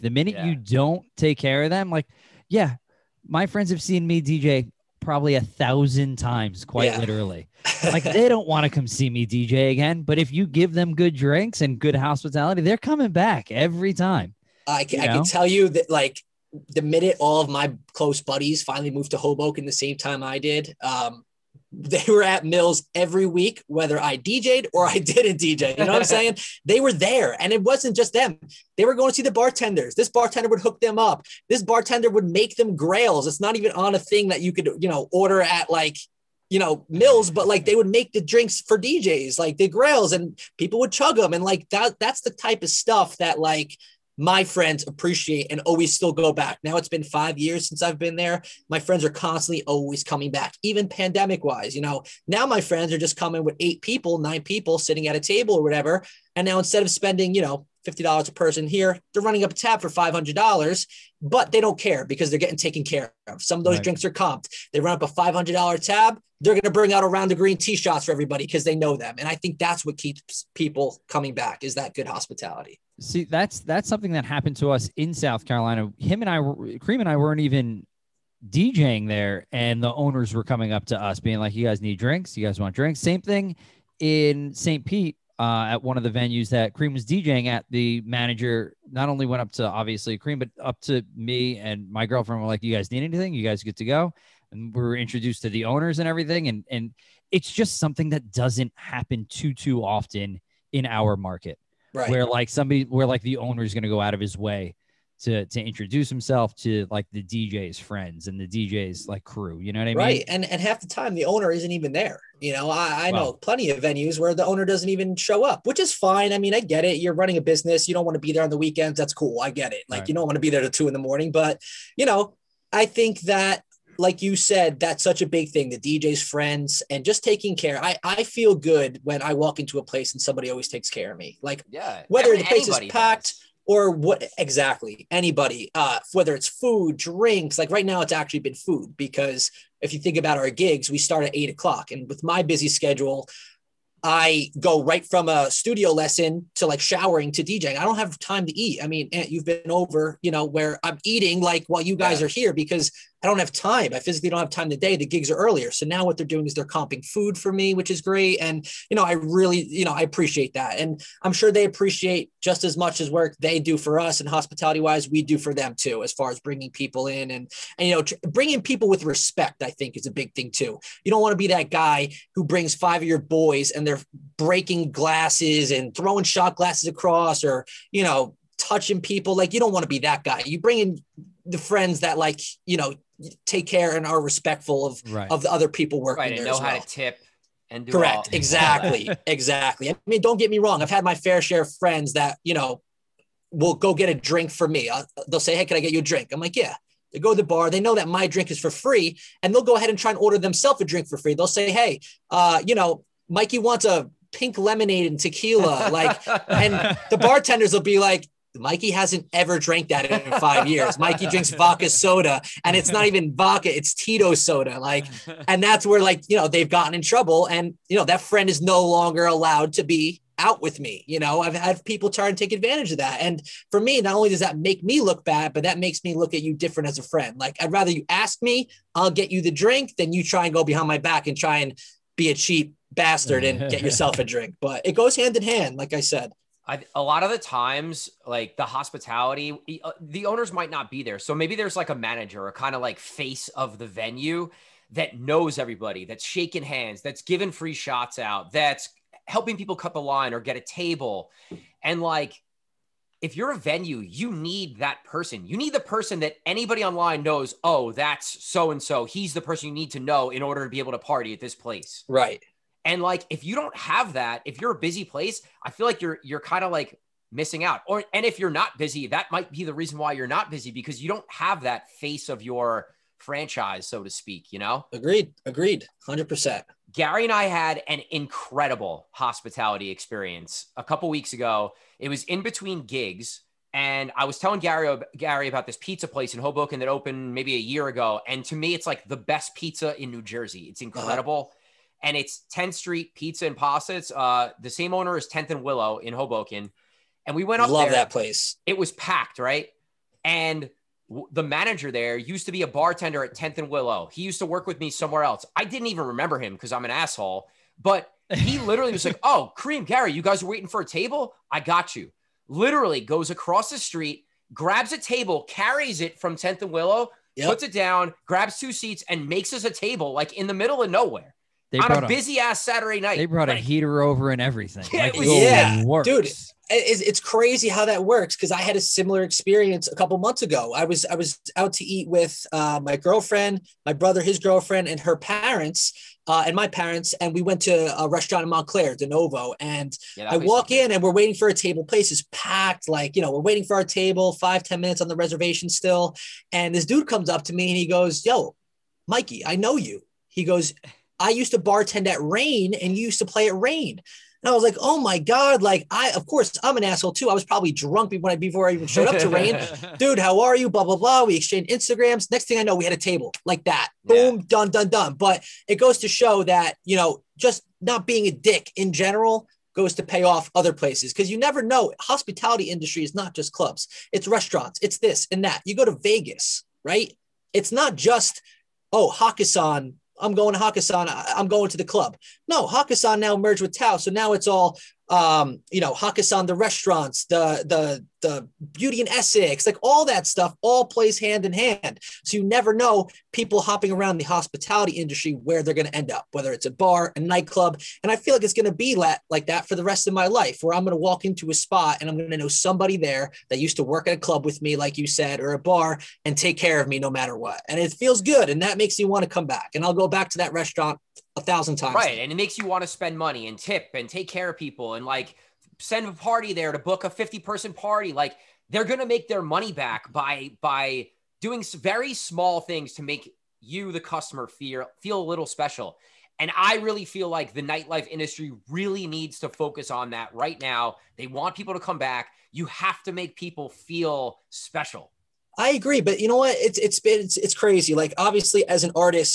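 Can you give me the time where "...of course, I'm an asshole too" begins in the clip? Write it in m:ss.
5:56.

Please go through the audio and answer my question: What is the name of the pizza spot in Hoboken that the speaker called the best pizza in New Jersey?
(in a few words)
10th Street Pizza and Pasta.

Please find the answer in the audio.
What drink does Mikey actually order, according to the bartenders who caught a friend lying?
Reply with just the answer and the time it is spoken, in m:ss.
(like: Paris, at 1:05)
Tito soda, at 3:33.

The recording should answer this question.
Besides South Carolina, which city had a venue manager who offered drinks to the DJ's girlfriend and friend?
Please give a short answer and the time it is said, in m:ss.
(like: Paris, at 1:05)
St. Pete, at 1:24.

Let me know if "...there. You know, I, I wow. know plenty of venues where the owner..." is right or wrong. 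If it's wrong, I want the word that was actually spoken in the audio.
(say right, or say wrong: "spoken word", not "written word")
right.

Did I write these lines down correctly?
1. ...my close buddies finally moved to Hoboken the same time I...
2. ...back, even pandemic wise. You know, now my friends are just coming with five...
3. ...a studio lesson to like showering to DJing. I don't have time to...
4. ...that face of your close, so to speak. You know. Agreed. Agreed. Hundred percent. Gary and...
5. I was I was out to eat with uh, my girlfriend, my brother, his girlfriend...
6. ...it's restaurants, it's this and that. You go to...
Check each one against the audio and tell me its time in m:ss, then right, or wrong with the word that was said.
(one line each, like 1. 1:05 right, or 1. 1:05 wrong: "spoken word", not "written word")
1. 0:17 right
2. 0:50 wrong: "eight", not "five"
3. 2:25 right
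4. 4:31 wrong: "franchise", not "close"
5. 5:30 right
6. 6:14 right.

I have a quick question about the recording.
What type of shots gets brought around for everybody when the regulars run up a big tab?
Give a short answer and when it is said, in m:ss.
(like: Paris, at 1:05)
green tea, at 1:07.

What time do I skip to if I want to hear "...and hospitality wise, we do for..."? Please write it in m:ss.
2:44.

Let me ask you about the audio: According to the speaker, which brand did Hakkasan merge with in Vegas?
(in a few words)
Tao.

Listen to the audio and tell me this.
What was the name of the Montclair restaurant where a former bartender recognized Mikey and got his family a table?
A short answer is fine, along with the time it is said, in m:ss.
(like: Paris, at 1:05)
De Novo, at 5:38.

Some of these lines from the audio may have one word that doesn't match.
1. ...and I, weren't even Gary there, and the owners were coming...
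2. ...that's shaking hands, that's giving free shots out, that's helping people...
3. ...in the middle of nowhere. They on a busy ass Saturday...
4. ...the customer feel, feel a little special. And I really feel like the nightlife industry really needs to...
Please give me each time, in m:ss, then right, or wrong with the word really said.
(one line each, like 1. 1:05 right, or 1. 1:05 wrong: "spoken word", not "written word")
1. 1:16 wrong: "DJing", not "Gary"
2. 4:06 right
3. 5:20 right
4. 7:03 right.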